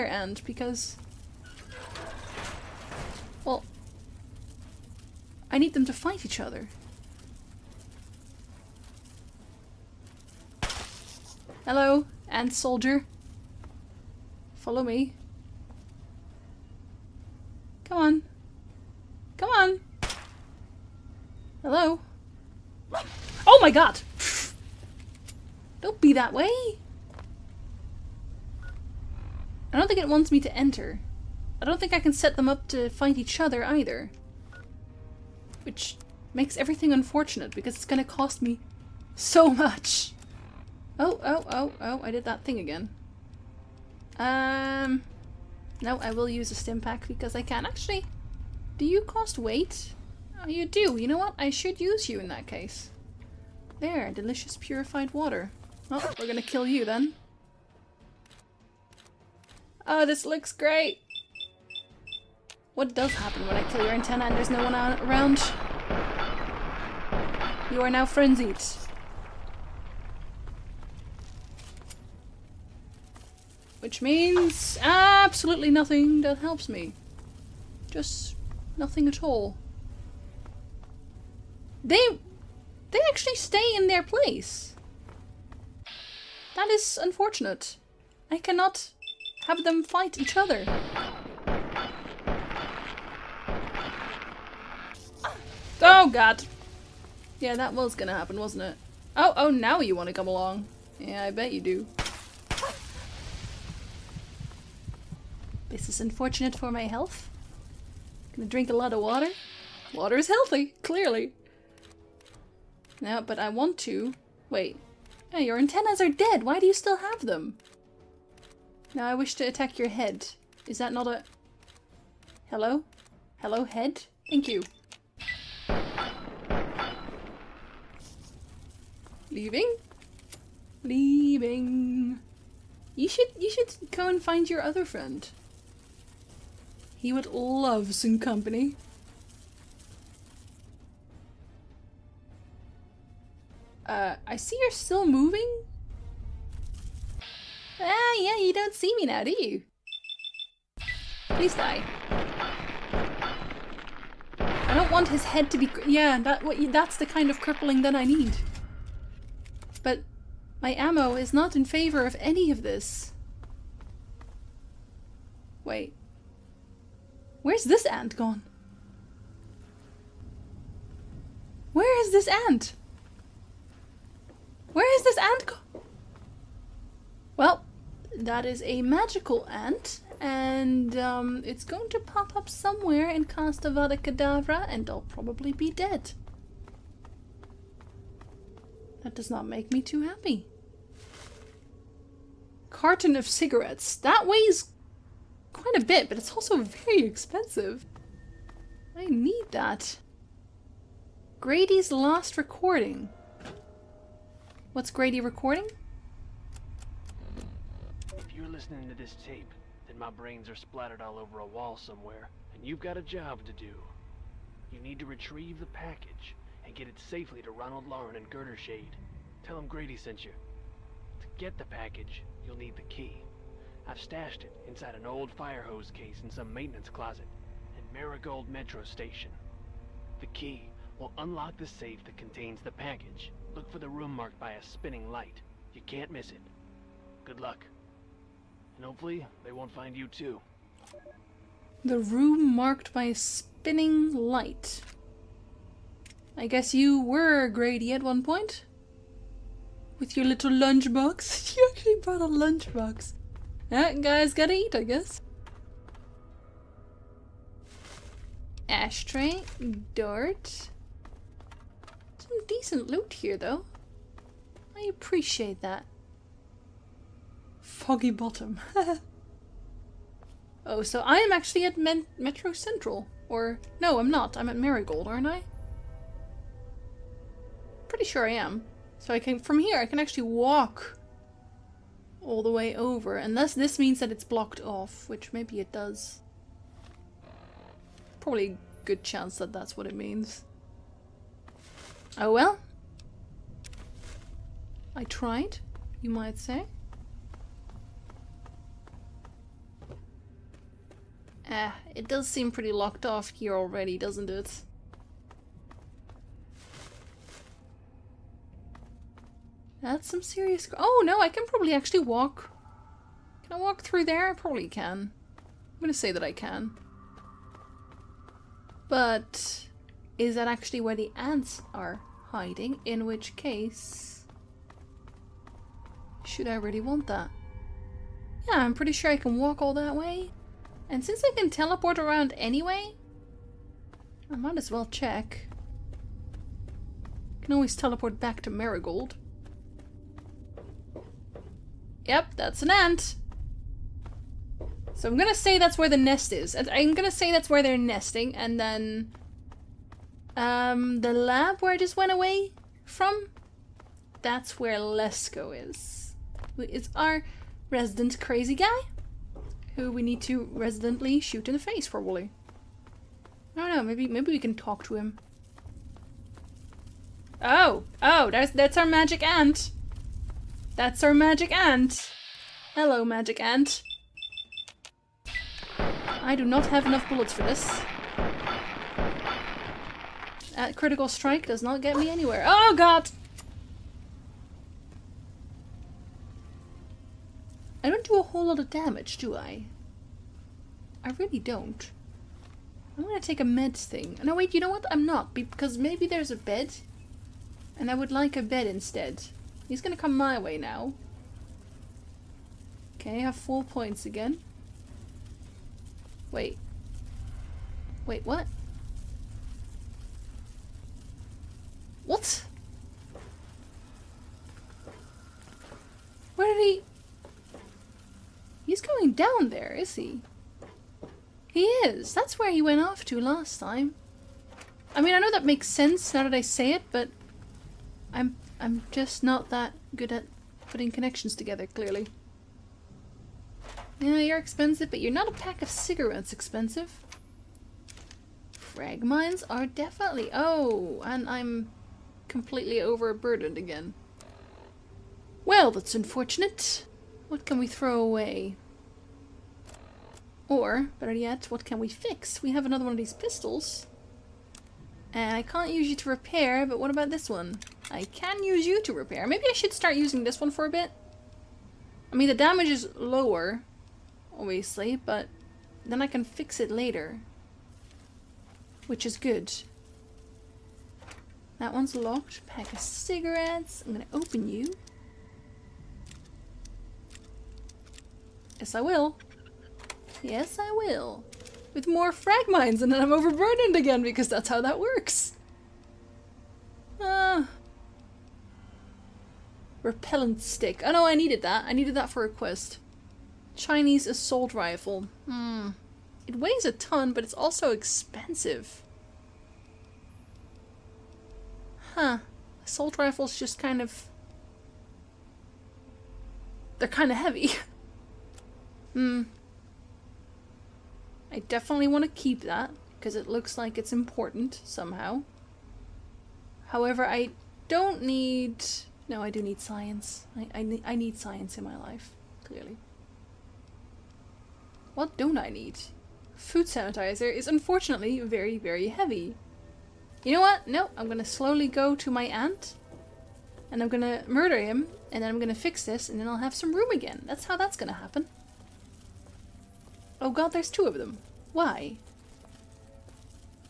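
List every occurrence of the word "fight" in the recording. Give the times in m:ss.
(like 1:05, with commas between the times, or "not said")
0:05, 0:32, 1:29.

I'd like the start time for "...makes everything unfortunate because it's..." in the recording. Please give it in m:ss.
0:36.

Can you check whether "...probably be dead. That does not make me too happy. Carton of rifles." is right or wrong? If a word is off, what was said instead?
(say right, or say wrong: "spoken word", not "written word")
wrong: "cigarettes", not "rifles".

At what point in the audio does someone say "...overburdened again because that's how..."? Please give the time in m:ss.
8:03.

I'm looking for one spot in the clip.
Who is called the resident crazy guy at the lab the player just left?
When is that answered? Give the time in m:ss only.
5:54.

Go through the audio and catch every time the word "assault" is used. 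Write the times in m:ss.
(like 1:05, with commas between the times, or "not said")
8:14, 8:22.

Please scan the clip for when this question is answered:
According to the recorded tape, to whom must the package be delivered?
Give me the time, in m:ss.
3:37.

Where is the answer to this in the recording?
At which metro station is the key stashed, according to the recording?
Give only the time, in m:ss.
3:47.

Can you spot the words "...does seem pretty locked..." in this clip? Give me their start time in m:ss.
5:02.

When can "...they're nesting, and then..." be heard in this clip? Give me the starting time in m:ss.
5:47.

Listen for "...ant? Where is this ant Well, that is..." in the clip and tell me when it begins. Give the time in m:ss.
2:52.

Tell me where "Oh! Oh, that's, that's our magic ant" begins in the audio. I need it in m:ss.
6:07.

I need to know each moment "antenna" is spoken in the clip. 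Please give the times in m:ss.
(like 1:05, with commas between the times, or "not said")
1:03, 1:55.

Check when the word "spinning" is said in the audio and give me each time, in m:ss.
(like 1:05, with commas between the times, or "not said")
3:54, 4:03.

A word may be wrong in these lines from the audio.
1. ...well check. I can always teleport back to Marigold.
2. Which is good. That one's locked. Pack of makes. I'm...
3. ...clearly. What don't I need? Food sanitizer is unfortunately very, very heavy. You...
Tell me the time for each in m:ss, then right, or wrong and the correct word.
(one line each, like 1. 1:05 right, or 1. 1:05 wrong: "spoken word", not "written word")
1. 5:34 right
2. 7:48 wrong: "cigarettes", not "makes"
3. 8:42 right.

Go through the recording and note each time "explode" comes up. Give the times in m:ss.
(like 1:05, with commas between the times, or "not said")
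not said.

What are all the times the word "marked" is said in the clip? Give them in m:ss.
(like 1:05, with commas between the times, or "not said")
3:54, 4:02.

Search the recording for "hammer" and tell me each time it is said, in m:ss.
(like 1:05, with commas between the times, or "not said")
not said.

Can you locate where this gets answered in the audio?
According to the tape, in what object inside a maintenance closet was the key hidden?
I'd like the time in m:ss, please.
3:45.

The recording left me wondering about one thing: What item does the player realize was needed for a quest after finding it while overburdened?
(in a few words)
Repellent stick.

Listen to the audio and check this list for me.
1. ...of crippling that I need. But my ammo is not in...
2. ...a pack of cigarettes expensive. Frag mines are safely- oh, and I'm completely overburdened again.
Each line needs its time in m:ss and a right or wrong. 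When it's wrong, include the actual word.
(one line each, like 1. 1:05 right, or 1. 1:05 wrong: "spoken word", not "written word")
1. 2:37 right
2. 7:15 wrong: "definitely", not "safely".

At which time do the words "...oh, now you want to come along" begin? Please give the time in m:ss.
1:39.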